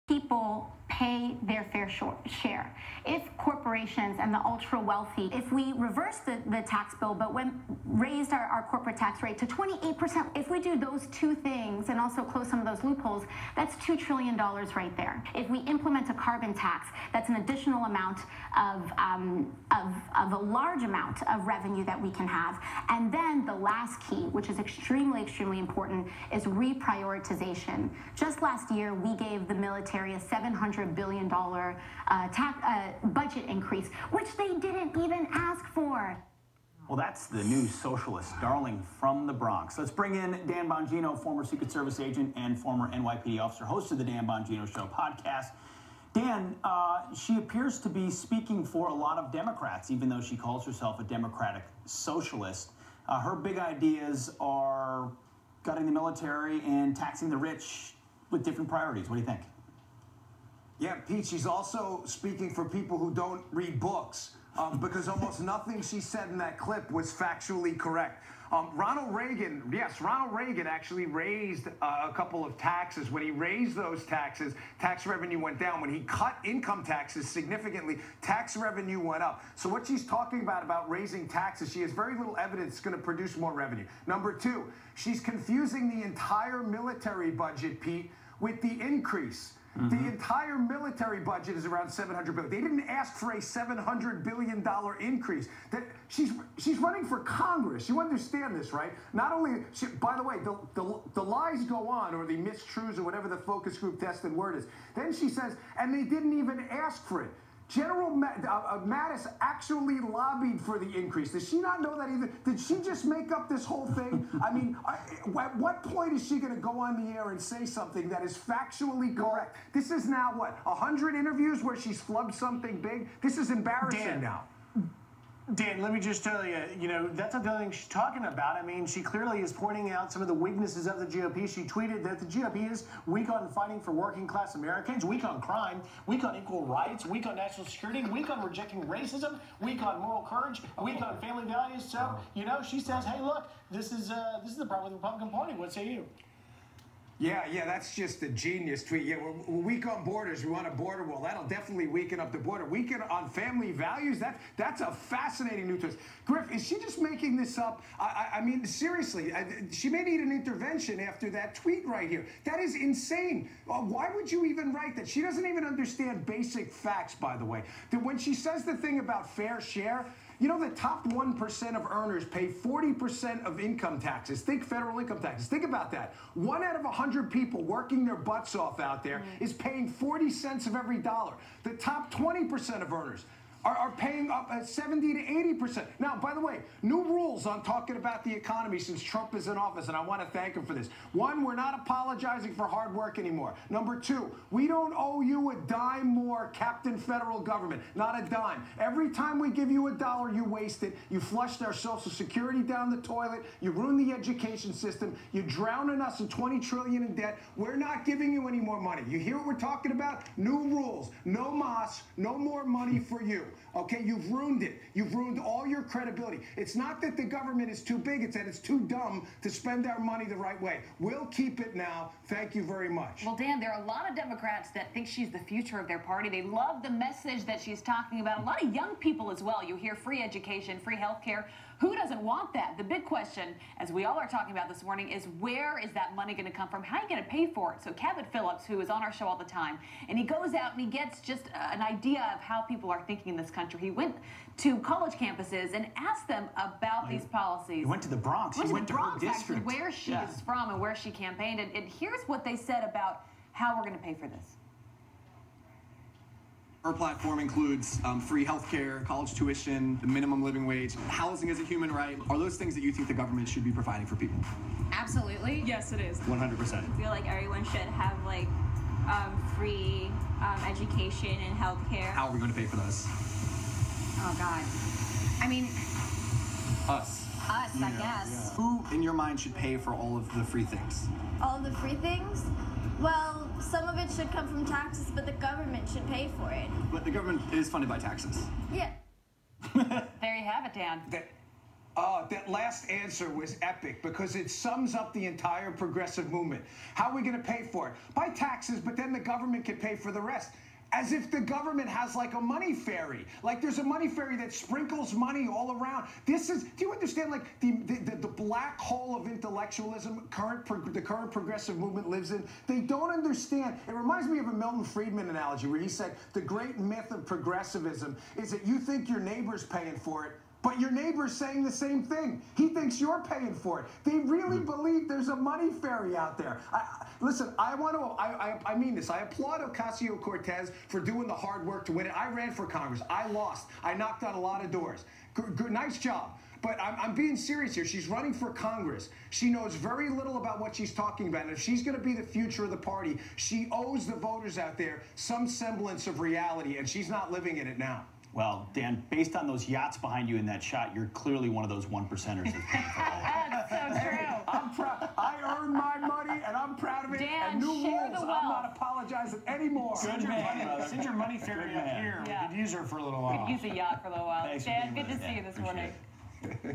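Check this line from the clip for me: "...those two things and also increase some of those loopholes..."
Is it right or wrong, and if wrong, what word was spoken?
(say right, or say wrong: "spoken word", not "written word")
wrong: "close", not "increase".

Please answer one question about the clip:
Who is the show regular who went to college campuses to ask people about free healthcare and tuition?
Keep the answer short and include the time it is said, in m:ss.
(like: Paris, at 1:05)
Cabot Phillips, at 3:57.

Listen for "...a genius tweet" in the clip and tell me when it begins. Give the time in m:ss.
2:28.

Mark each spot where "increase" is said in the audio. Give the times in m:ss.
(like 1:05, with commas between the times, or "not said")
0:33, 1:28, 1:34, 1:50.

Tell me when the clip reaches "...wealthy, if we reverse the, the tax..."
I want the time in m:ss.
0:04.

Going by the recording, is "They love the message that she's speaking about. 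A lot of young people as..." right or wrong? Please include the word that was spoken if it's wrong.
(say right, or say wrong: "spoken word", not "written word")
wrong: "talking", not "speaking".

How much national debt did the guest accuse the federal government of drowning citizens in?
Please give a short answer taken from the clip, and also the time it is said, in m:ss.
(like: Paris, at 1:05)
20 trillion, at 3:26.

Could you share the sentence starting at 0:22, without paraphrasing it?
And then the last key, which is extremely, extremely important, is reprioritization.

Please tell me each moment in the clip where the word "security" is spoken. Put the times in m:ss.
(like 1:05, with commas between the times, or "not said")
2:17, 3:22.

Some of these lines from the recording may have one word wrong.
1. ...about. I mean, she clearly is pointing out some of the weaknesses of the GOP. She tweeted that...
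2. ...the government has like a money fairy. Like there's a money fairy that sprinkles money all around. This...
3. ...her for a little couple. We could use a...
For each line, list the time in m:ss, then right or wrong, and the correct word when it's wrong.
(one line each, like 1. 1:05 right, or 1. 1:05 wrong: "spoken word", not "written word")
1. 2:08 right
2. 5:01 right
3. 6:02 wrong: "while", not "couple".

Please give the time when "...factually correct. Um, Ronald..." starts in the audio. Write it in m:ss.
1:07.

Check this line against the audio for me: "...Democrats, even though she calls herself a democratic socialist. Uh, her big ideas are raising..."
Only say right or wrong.
wrong.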